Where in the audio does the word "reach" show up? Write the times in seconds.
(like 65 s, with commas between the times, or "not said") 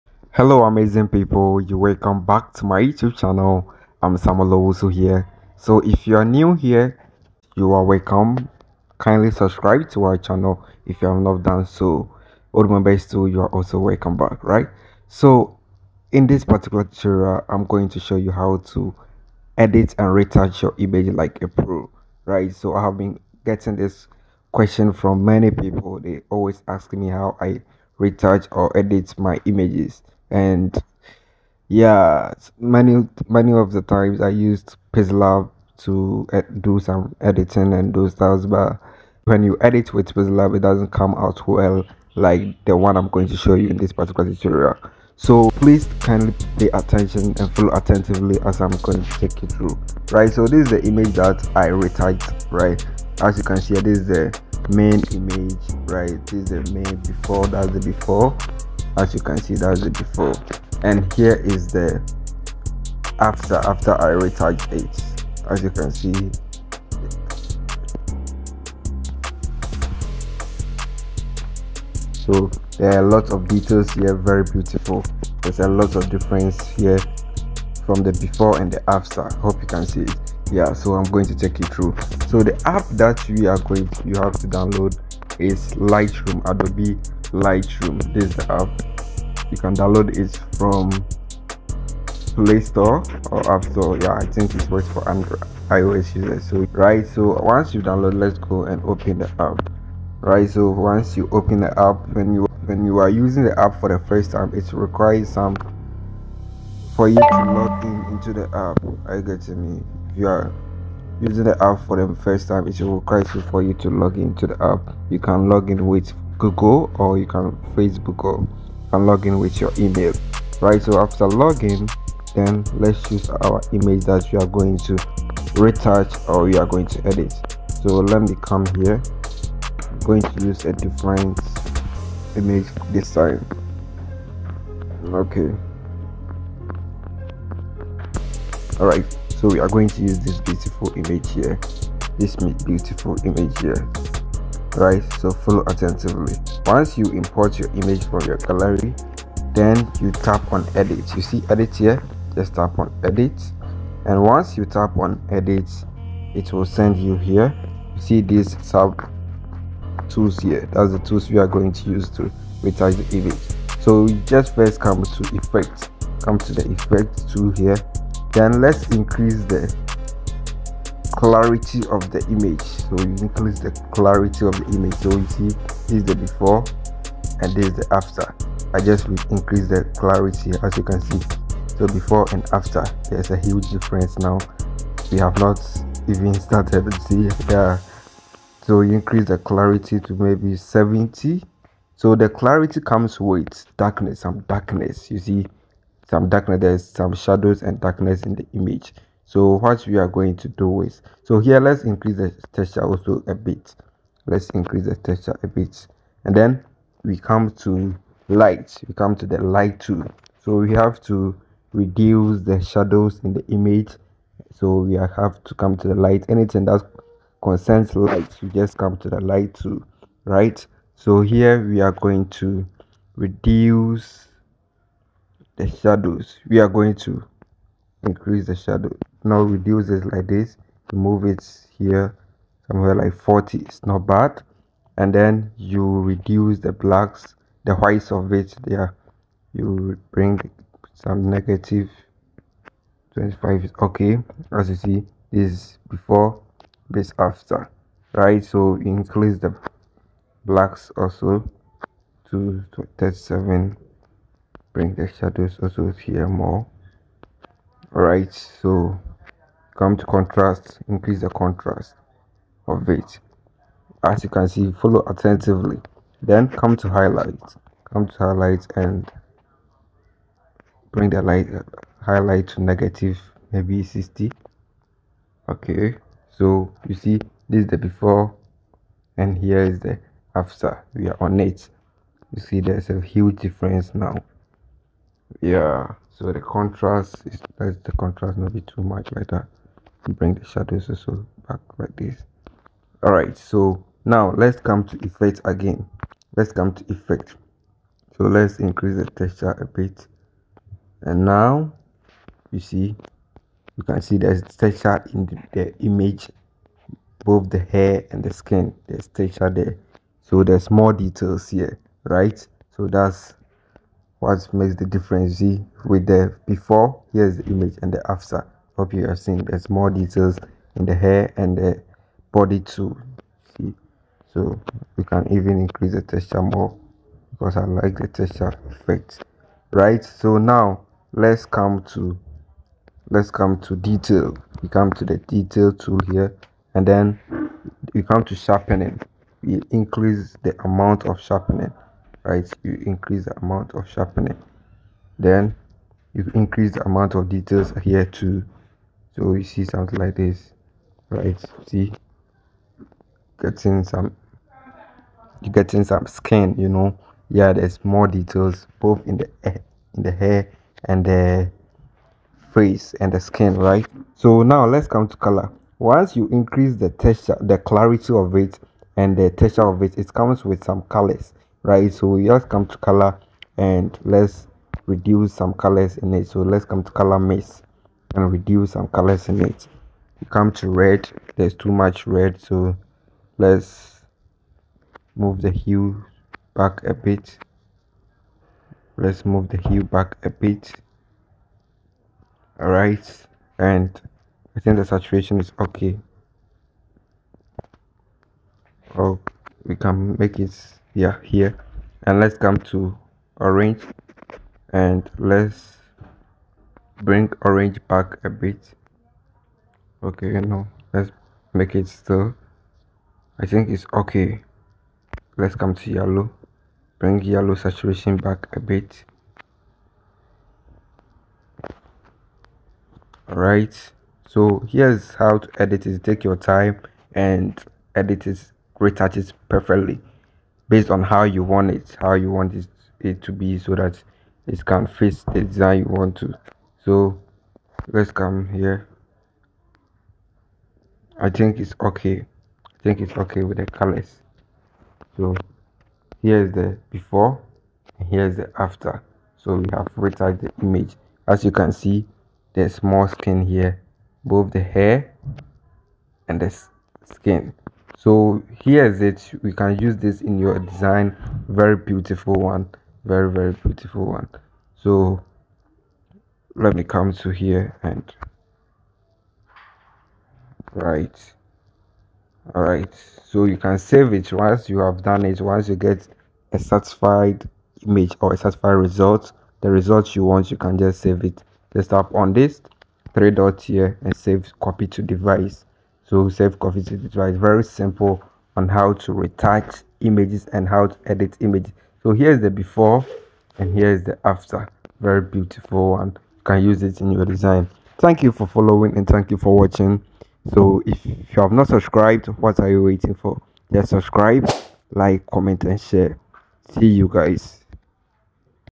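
not said.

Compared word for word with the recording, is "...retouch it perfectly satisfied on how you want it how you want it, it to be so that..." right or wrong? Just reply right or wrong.
wrong.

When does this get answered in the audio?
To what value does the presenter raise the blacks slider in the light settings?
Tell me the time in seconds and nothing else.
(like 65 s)
252 s.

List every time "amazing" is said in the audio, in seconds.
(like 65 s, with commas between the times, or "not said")
0 s.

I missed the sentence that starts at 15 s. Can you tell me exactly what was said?
So in this particular tutorial, I'm going to show you how to edit and retouch your image like a pro, right?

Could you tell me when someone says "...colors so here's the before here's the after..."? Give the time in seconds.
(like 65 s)
443 s.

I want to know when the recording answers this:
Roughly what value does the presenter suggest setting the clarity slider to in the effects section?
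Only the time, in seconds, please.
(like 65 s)
190 s.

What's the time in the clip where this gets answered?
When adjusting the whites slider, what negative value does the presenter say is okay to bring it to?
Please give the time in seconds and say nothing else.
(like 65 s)
241 s.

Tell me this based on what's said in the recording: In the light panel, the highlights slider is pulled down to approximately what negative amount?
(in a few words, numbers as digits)
-60.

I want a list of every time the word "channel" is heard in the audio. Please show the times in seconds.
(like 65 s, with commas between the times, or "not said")
3 s, 10 s.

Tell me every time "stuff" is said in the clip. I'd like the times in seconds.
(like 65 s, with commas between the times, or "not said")
38 s.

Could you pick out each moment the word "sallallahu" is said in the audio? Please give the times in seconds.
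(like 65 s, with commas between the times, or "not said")
not said.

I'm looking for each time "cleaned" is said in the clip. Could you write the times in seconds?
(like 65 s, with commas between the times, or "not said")
not said.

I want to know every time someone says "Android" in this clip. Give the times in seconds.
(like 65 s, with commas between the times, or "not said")
95 s.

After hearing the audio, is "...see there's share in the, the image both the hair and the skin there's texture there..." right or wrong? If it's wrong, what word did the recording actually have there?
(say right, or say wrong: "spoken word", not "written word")
wrong: "texture", not "share".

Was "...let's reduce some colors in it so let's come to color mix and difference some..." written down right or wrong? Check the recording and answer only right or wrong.
wrong.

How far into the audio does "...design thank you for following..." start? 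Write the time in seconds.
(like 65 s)
497 s.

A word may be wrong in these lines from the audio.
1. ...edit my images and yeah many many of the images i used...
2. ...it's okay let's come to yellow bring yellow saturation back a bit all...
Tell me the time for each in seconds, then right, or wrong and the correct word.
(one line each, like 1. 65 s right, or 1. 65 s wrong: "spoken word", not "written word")
1. 28 s wrong: "times", not "images"
2. 413 s right.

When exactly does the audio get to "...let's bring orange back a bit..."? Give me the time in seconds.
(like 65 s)
405 s.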